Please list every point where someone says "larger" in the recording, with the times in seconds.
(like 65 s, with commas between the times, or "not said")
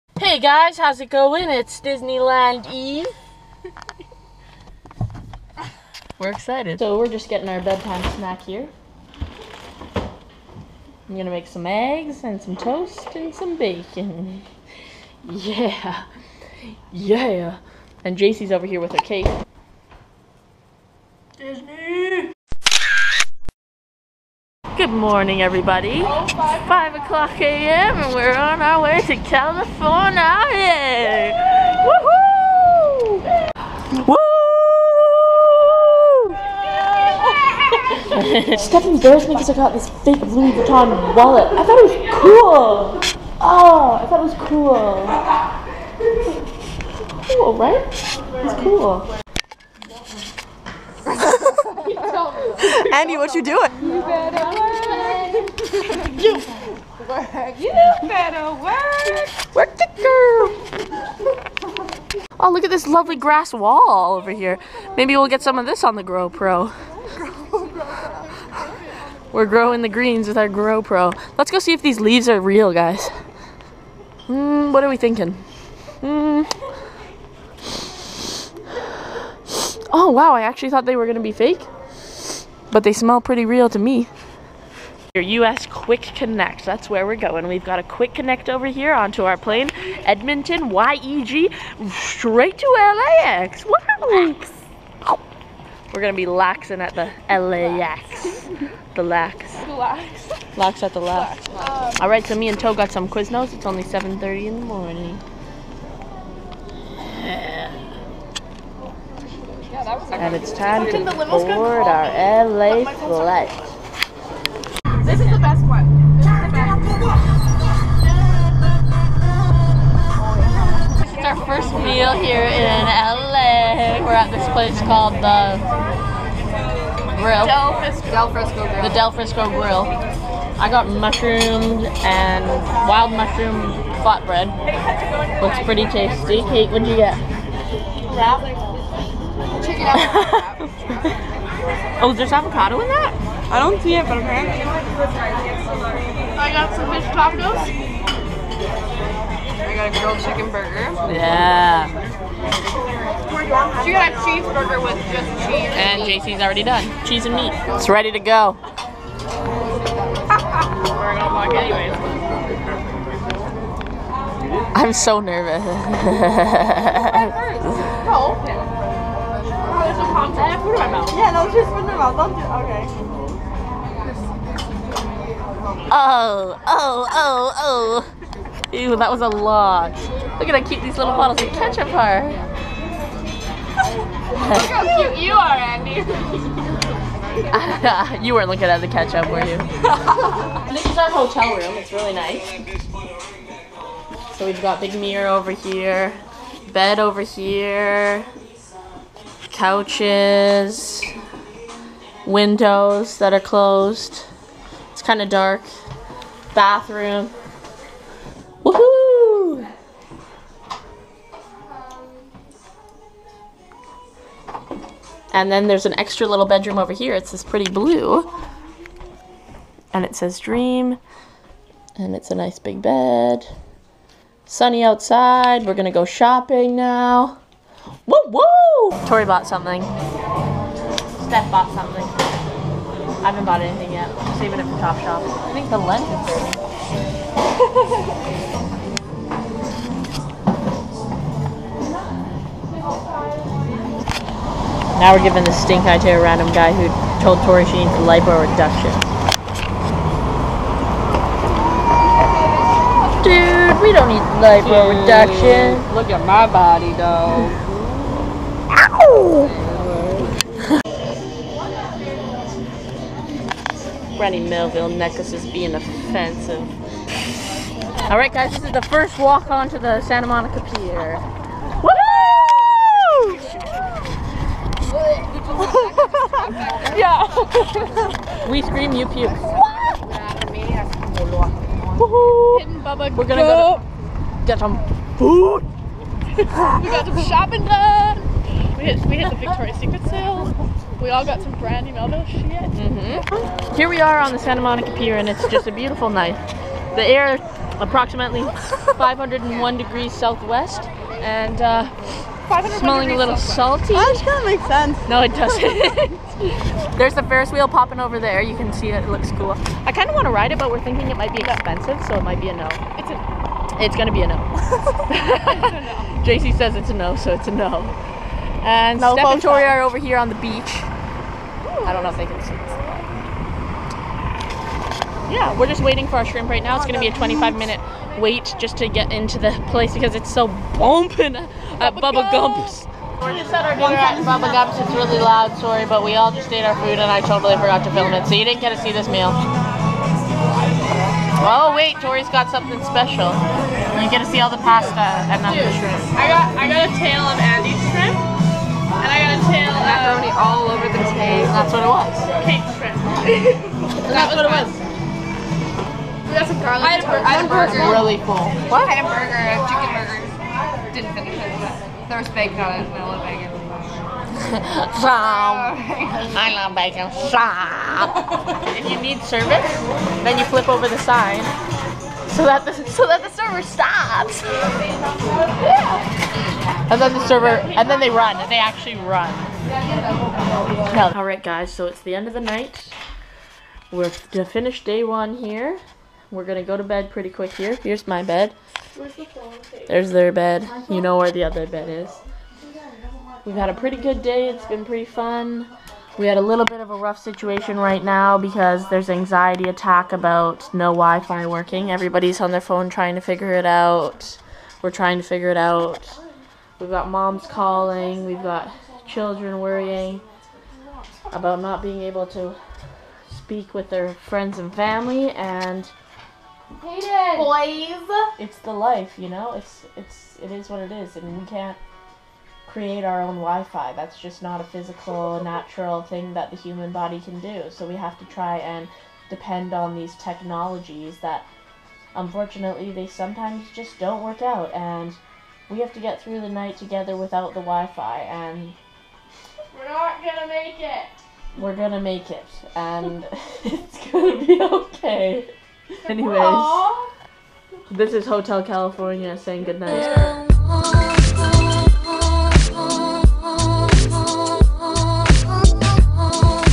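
not said.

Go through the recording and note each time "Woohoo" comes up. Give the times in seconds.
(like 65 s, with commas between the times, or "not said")
33 s, 208 s.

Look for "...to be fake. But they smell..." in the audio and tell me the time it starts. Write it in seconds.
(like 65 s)
81 s.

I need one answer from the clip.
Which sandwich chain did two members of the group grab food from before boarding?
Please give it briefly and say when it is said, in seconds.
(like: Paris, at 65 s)
Quiznos, at 103 s.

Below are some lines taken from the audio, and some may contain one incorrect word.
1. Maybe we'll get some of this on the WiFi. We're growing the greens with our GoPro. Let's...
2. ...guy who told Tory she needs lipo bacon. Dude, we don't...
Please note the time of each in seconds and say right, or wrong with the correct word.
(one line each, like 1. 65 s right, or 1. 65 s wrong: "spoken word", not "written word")
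1. 64 s wrong: "GoPro", not "WiFi"
2. 246 s wrong: "reduction", not "bacon".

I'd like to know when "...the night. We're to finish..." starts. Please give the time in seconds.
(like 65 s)
382 s.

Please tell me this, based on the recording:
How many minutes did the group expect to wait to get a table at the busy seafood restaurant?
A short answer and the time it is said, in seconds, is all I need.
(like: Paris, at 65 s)
25, at 327 s.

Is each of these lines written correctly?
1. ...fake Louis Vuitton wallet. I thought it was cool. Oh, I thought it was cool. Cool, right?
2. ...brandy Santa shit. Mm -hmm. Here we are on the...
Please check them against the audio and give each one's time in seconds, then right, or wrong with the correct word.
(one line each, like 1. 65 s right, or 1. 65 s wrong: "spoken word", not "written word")
1. 40 s right
2. 291 s wrong: "Melville", not "Santa".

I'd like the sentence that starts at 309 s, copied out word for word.
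I kind of want to ride it, but we're thinking it might be expensive, so it might be a no.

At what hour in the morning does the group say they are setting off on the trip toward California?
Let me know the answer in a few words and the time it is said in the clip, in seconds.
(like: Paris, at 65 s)
5 a.m., at 26 s.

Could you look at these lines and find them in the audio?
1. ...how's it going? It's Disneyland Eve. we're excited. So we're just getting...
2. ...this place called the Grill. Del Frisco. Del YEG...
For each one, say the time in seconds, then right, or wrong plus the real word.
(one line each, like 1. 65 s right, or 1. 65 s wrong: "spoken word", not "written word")
1. 0 s right
2. 124 s wrong: "Frisco", not "YEG".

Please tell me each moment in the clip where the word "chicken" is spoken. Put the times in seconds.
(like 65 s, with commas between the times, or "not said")
139 s, 150 s, 359 s.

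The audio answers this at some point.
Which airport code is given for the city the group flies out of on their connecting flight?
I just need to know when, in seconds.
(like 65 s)
90 s.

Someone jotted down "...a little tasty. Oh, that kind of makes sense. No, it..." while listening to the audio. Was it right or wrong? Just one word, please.
wrong.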